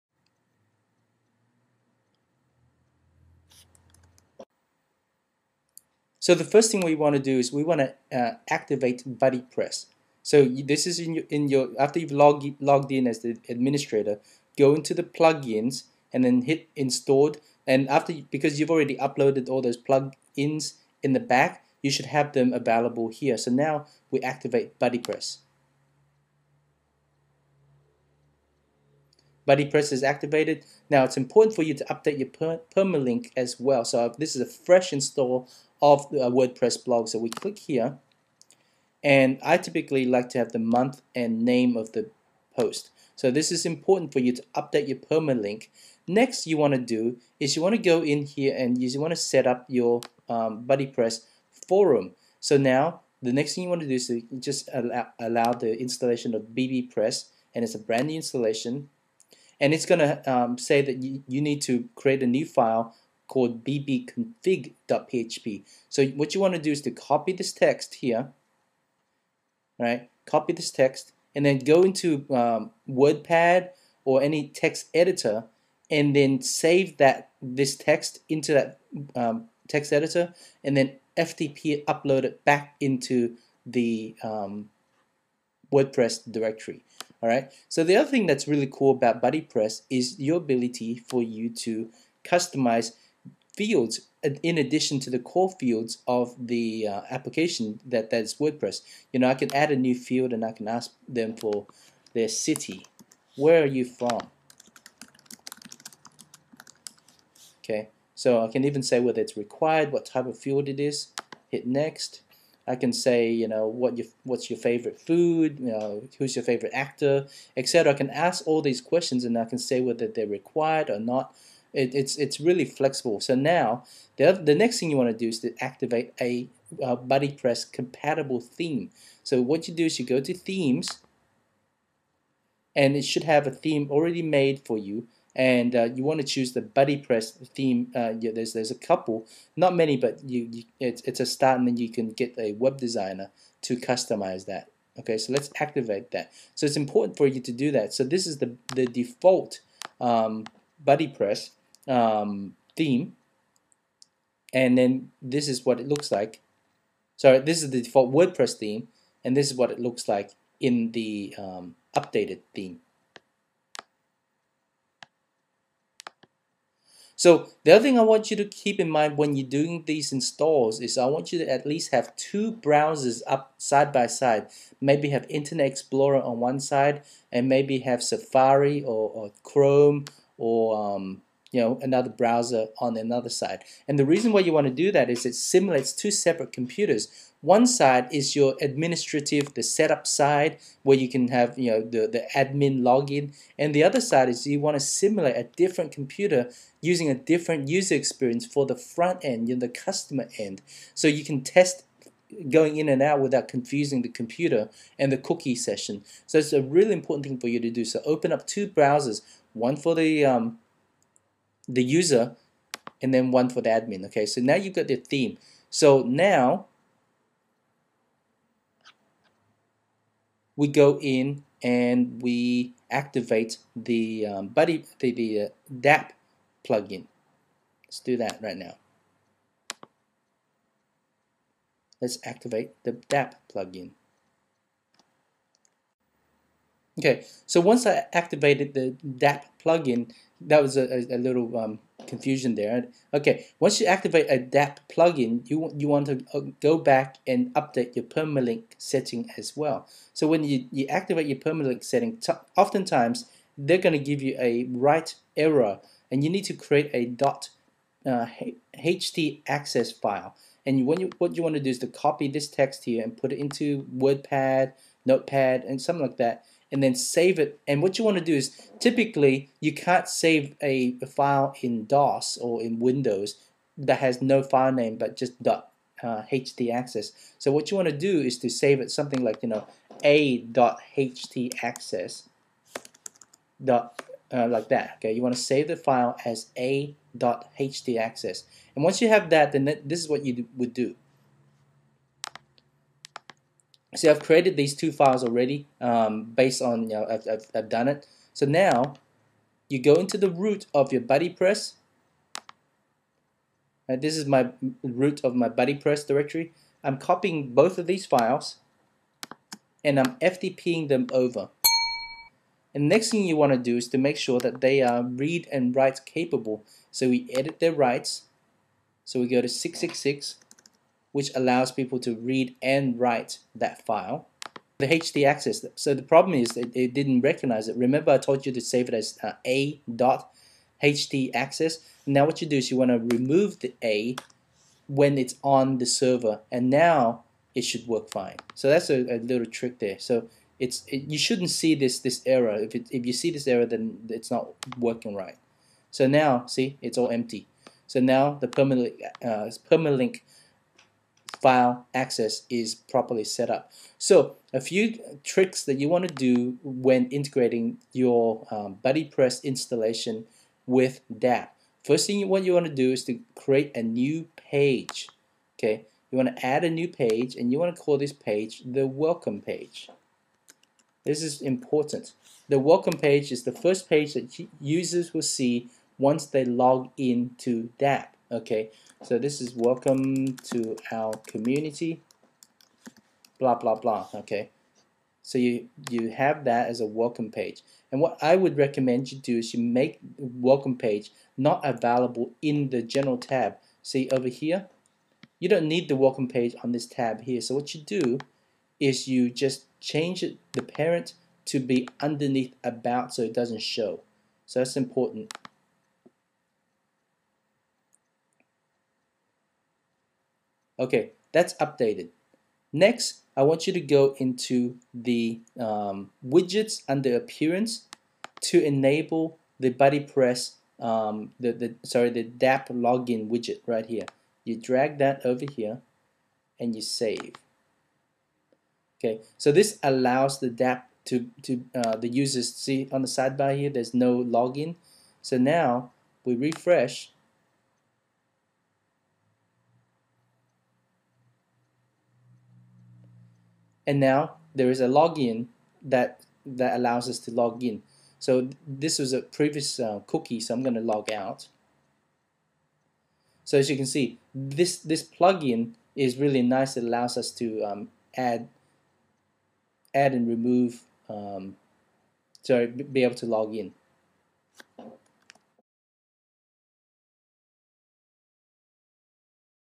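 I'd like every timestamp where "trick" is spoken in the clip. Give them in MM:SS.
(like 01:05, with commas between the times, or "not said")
05:39, 05:55.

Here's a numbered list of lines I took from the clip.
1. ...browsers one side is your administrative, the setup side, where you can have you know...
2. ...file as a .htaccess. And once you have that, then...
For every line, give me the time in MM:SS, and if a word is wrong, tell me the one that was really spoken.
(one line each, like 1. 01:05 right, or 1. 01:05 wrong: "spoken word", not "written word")
1. 03:06 wrong: "computers", not "browsers"
2. 04:45 right.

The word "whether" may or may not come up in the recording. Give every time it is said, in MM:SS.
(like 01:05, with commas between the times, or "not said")
01:48, 01:59.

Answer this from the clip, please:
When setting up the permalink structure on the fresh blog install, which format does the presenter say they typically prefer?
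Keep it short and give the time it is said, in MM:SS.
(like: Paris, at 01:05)
Month and name, at 00:40.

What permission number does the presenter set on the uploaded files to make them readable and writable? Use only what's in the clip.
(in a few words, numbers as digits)
666.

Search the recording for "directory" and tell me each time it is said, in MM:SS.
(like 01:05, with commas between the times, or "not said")
01:26, 05:06.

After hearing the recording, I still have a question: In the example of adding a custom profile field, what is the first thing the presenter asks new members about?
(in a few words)
Their city.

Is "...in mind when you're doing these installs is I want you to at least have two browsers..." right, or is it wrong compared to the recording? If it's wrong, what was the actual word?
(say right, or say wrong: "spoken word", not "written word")
right.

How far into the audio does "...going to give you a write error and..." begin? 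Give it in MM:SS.
04:13.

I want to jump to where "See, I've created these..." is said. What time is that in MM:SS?
04:53.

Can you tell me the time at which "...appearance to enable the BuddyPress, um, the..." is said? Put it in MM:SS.
06:57.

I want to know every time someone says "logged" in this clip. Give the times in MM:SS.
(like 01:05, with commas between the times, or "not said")
00:12.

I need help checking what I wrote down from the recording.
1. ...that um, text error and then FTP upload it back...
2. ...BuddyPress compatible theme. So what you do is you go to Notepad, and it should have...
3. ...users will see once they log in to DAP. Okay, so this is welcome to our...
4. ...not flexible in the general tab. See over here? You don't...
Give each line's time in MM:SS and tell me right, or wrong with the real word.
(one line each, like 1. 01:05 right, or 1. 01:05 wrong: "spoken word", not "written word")
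1. 01:18 wrong: "editor", not "error"
2. 02:06 wrong: "Themes", not "Notepad"
3. 06:14 right
4. 06:31 wrong: "available", not "flexible".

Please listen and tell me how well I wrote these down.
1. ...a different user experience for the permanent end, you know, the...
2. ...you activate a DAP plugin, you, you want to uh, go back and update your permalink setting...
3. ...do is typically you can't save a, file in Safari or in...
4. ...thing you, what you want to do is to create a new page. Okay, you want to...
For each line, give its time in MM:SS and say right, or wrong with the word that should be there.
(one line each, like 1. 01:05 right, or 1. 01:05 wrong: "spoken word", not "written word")
1. 03:17 wrong: "front", not "permanent"
2. 04:03 right
3. 04:28 wrong: "DOS", not "Safari"
4. 06:02 right.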